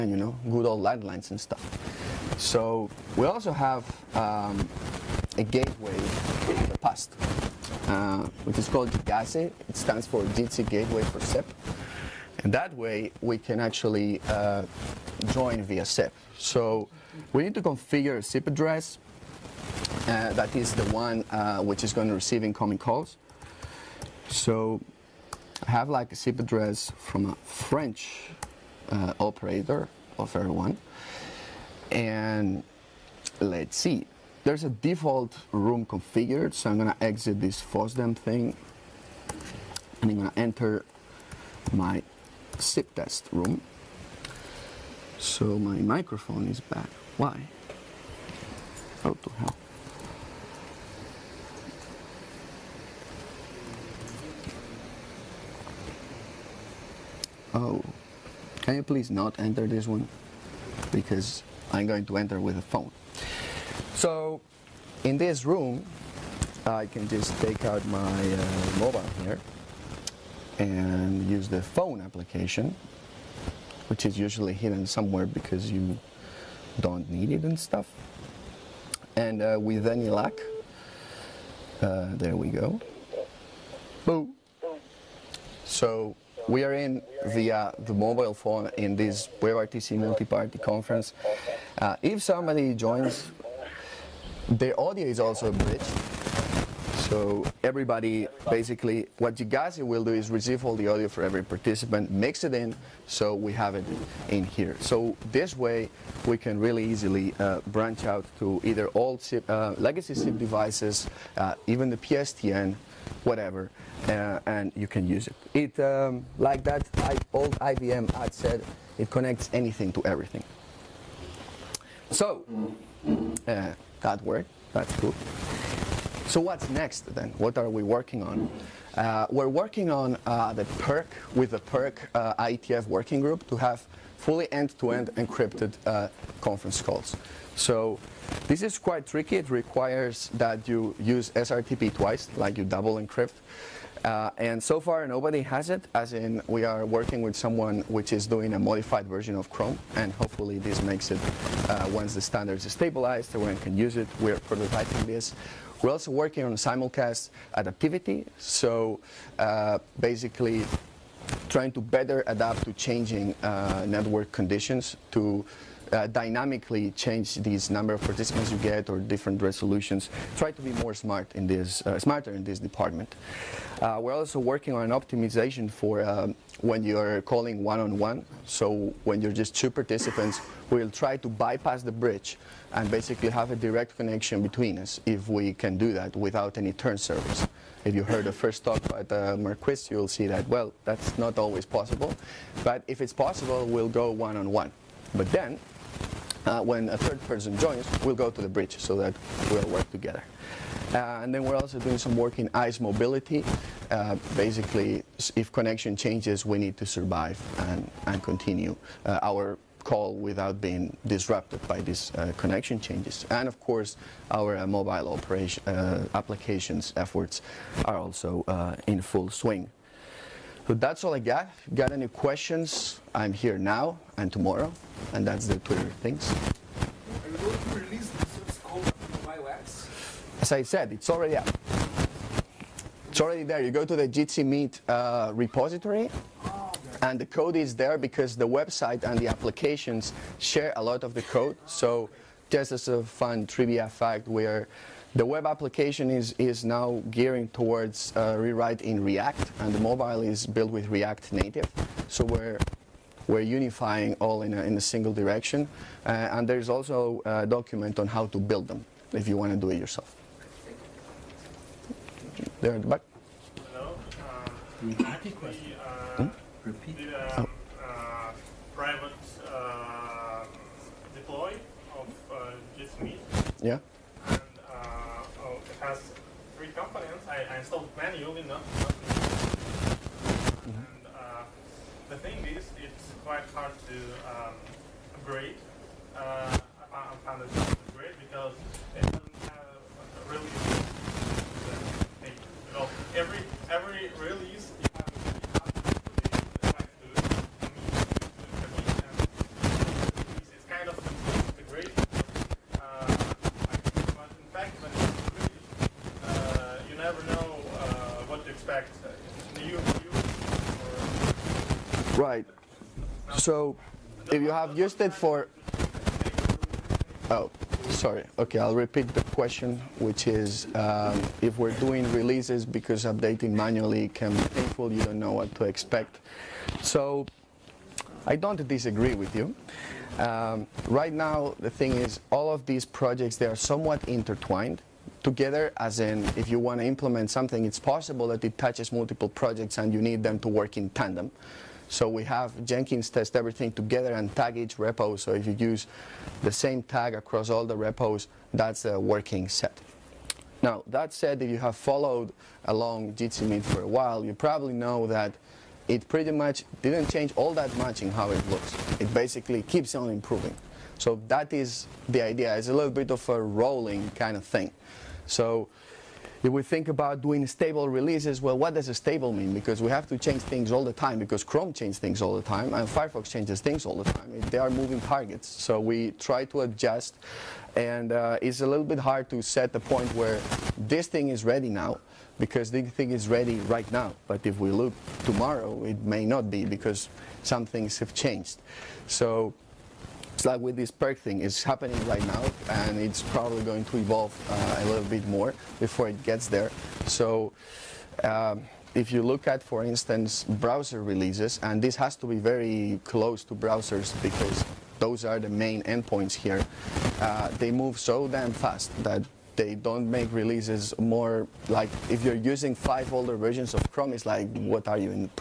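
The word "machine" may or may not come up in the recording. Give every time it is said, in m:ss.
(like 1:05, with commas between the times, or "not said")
not said.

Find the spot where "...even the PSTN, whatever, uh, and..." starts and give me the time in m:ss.
1:51.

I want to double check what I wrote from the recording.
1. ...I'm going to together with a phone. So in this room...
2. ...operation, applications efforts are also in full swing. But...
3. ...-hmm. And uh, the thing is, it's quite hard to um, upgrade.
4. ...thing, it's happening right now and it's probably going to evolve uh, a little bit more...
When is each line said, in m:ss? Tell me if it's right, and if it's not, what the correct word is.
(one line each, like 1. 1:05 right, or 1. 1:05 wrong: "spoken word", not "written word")
1. 1:01 wrong: "enter", not "together"
2. 3:35 right
3. 4:40 right
4. 6:31 right.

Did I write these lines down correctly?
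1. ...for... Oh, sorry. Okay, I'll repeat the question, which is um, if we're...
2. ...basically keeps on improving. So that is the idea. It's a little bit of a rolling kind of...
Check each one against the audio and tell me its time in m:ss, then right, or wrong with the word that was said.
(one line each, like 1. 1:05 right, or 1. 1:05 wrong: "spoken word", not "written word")
1. 5:15 right
2. 5:59 right.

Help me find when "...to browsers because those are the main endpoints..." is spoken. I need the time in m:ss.
6:43.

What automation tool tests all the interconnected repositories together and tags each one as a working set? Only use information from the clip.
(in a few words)
Jenkins.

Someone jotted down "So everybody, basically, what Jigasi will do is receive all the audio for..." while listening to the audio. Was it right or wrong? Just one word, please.
right.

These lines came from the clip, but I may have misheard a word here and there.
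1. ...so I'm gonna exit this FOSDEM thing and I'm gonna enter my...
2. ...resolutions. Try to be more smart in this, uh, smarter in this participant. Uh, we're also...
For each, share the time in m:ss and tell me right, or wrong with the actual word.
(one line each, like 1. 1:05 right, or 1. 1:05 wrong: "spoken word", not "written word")
1. 0:36 right
2. 2:49 wrong: "department", not "participant".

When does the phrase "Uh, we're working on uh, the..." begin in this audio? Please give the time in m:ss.
2:08.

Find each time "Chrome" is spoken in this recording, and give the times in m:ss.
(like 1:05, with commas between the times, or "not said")
2:29, 6:11, 6:53.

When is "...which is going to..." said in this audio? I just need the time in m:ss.
0:21.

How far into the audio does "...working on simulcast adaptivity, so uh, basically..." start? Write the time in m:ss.
2:36.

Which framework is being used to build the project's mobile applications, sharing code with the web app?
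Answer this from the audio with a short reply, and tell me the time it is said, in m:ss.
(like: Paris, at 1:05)
React Native, at 4:10.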